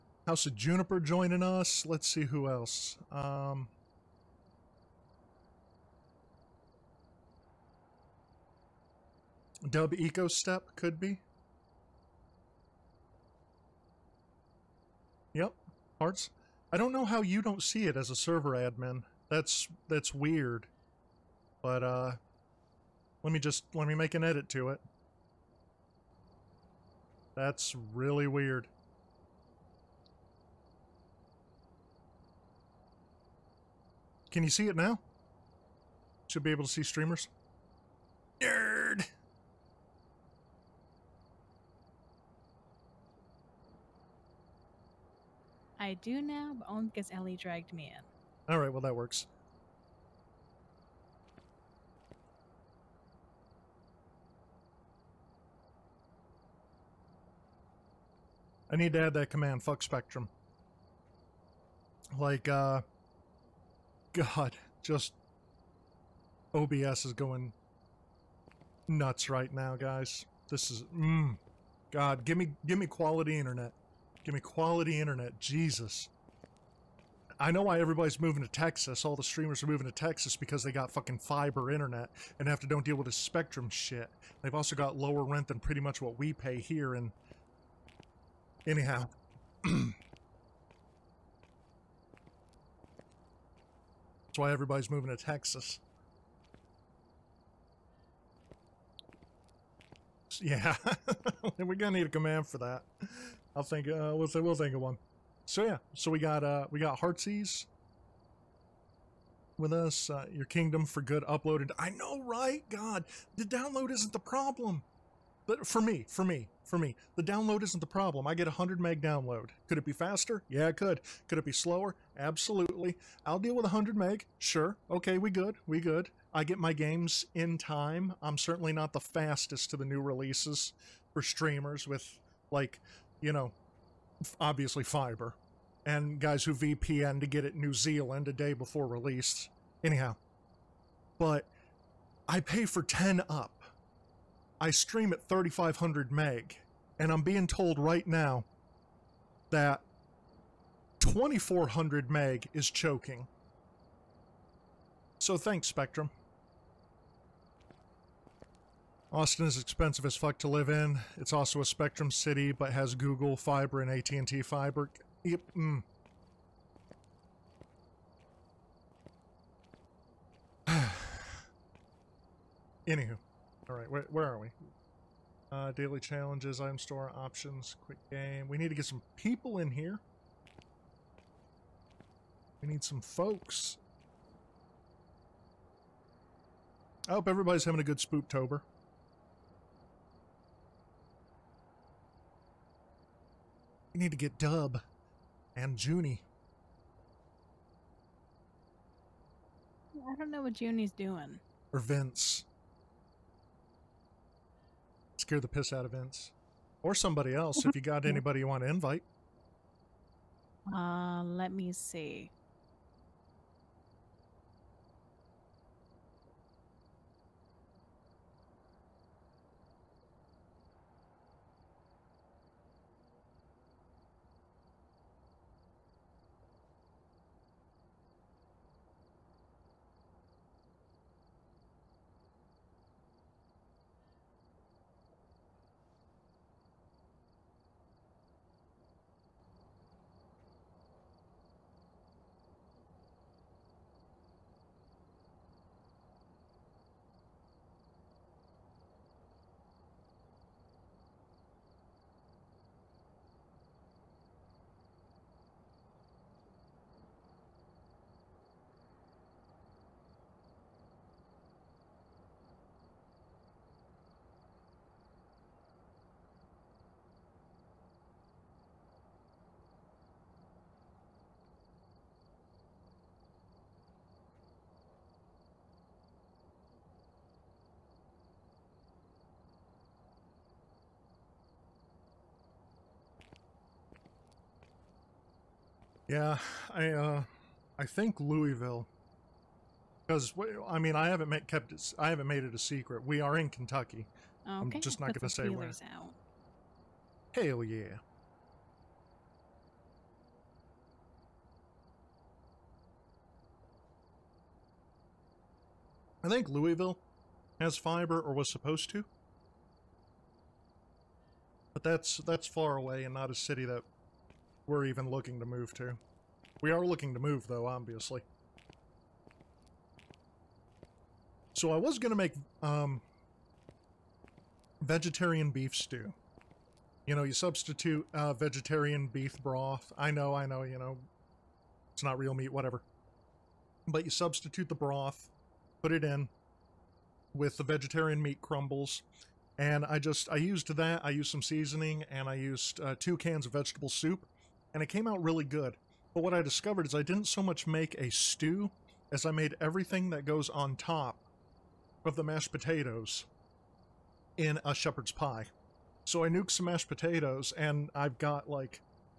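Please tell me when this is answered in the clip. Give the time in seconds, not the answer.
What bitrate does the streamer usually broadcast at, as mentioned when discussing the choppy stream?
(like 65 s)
145 s.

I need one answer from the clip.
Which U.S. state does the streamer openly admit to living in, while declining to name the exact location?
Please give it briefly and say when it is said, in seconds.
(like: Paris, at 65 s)
Kentucky, at 293 s.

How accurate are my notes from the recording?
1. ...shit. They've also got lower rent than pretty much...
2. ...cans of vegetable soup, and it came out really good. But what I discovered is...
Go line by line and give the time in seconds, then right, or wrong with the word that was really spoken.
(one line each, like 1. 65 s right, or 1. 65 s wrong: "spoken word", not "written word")
1. 83 s right
2. 343 s right.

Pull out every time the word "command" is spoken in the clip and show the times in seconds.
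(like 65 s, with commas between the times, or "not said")
59 s, 102 s.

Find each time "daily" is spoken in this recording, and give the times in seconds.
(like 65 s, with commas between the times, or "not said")
175 s.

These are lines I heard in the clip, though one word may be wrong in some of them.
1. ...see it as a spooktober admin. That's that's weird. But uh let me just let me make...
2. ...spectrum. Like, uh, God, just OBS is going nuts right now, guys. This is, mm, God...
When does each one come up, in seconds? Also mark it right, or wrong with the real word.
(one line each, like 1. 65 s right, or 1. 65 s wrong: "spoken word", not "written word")
1. 17 s wrong: "server", not "spooktober"
2. 59 s right.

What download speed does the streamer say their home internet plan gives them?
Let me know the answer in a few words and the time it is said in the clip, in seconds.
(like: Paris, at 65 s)
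100 meg, at 118 s.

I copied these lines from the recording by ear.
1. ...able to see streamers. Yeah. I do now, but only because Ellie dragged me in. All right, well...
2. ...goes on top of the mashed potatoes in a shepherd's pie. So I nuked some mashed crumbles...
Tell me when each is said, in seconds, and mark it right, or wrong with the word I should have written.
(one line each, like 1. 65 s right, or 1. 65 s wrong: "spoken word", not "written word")
1. 36 s right
2. 350 s wrong: "potatoes", not "crumbles".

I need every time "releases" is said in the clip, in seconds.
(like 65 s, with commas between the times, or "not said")
130 s, 138 s.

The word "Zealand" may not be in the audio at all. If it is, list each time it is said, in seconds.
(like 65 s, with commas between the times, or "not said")
137 s.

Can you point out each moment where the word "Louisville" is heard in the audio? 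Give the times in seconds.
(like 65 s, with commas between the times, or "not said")
288 s, 306 s.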